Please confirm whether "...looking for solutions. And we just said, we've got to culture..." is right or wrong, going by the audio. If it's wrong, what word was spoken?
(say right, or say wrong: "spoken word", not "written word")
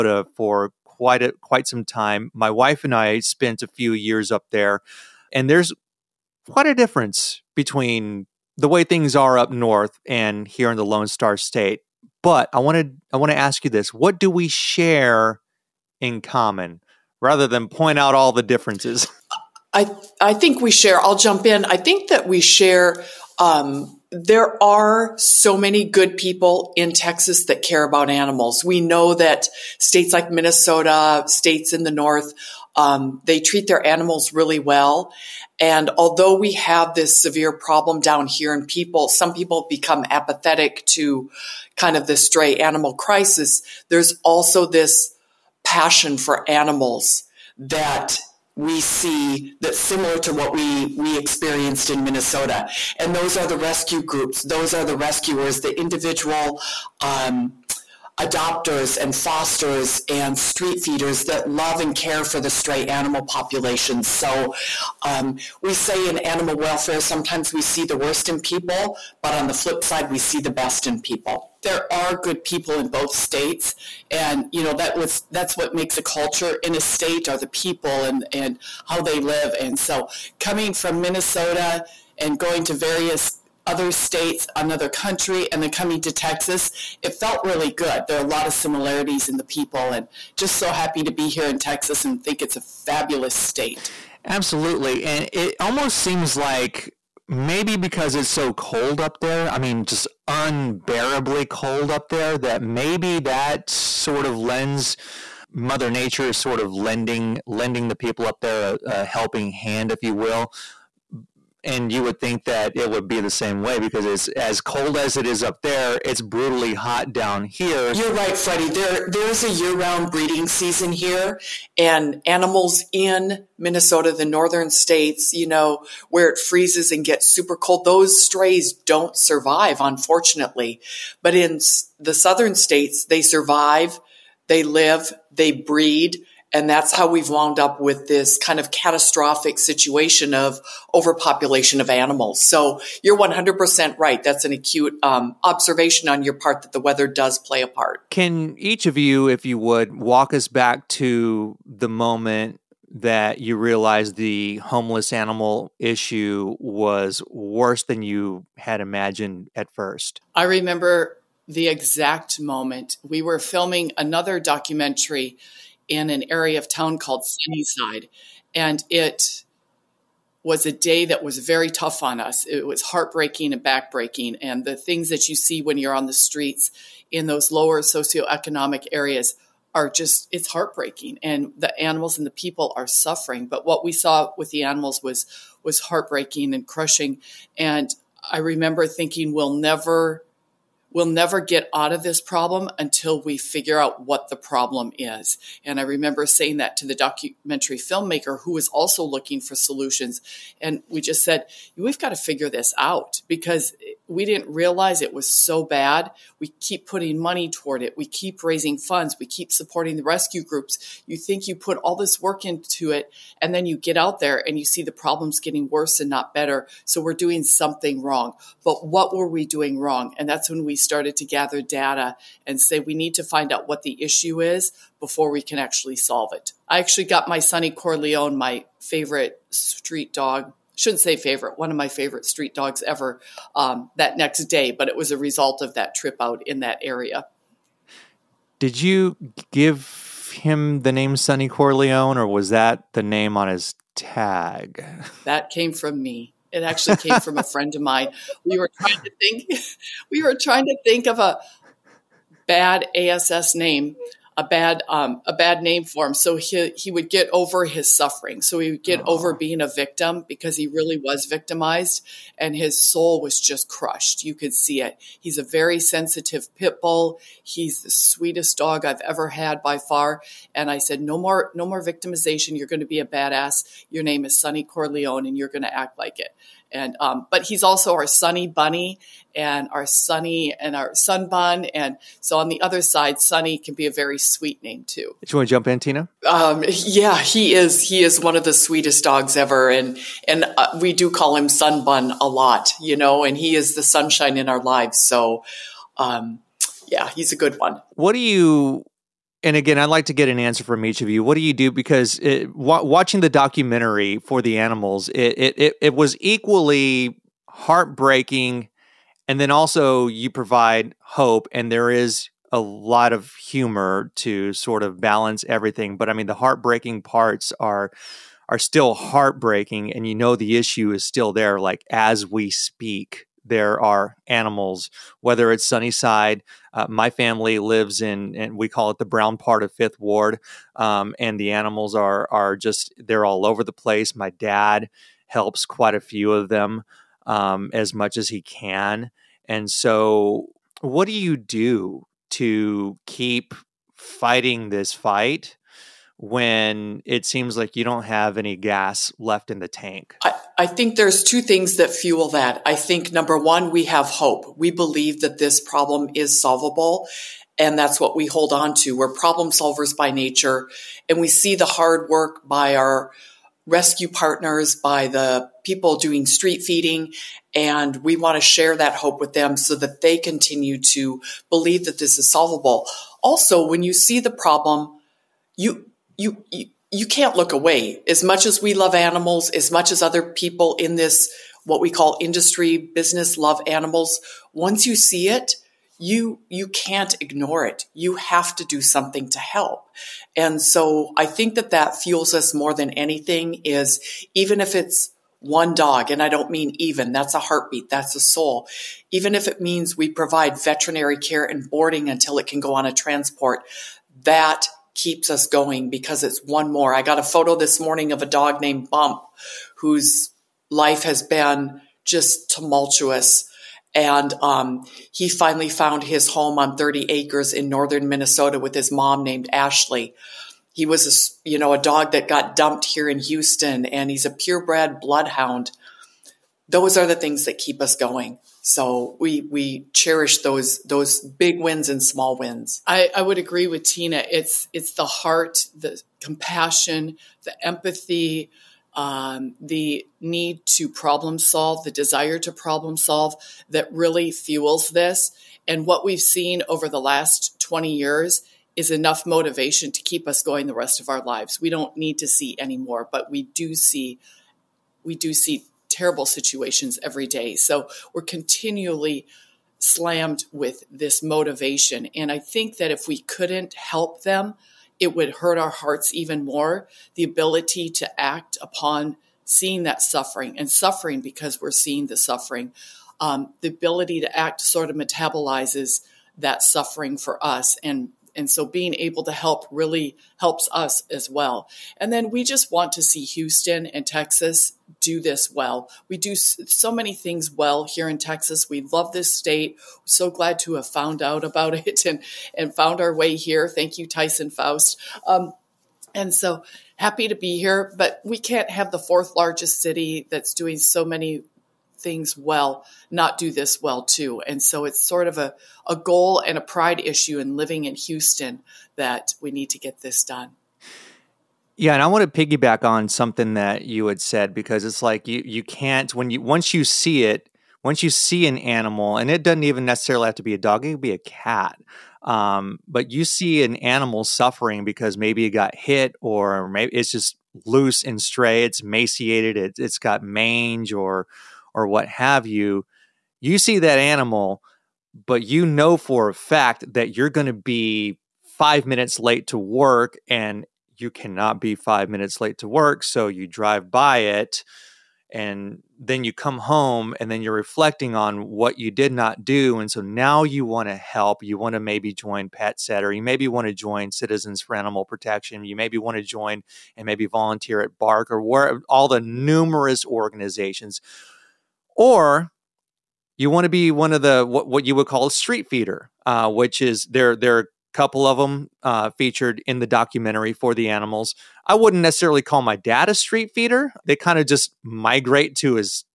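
wrong: "figure", not "culture".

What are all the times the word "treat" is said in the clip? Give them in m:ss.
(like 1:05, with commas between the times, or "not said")
0:33.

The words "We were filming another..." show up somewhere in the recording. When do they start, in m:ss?
2:43.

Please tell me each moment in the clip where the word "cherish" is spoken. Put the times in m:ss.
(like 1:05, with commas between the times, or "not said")
7:09.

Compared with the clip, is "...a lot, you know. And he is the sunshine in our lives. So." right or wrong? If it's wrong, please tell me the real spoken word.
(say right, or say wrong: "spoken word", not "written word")
right.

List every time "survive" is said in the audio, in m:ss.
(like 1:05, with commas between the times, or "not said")
2:09, 2:13.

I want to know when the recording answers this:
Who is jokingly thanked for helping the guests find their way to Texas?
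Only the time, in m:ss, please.
8:14.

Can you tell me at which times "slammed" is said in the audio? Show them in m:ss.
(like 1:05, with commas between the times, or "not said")
7:39.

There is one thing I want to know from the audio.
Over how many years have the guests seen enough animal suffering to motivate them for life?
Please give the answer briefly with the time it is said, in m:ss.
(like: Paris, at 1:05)
20, at 7:27.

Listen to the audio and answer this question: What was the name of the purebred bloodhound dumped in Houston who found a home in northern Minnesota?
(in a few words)
Bump.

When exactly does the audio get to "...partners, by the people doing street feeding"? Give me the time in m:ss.
6:04.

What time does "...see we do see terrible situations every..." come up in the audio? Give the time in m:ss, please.
7:33.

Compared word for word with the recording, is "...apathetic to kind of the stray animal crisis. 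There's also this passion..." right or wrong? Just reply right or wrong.
right.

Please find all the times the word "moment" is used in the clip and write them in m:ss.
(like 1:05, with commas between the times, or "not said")
2:31, 2:42.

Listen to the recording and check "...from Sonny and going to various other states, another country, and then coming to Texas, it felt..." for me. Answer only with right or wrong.
wrong.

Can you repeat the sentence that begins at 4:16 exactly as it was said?
So he he would get over his suffering.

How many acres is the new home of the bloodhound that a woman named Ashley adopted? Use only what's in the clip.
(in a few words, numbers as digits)
30.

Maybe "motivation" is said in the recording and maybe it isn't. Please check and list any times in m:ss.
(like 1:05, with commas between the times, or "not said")
7:29, 7:41.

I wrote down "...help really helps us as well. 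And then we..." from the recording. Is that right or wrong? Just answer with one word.
right.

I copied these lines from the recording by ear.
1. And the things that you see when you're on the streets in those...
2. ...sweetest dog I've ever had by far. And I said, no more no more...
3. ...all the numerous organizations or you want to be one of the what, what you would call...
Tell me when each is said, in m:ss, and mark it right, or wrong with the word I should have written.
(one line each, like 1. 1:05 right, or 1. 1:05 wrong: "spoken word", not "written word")
1. 2:54 right
2. 4:27 right
3. 9:18 right.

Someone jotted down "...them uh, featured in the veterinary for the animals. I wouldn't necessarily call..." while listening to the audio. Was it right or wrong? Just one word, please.
wrong.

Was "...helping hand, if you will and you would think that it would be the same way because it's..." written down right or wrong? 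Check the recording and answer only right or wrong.
right.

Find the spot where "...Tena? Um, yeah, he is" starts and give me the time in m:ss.
4:45.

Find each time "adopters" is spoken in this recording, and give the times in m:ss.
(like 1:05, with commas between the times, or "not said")
0:58.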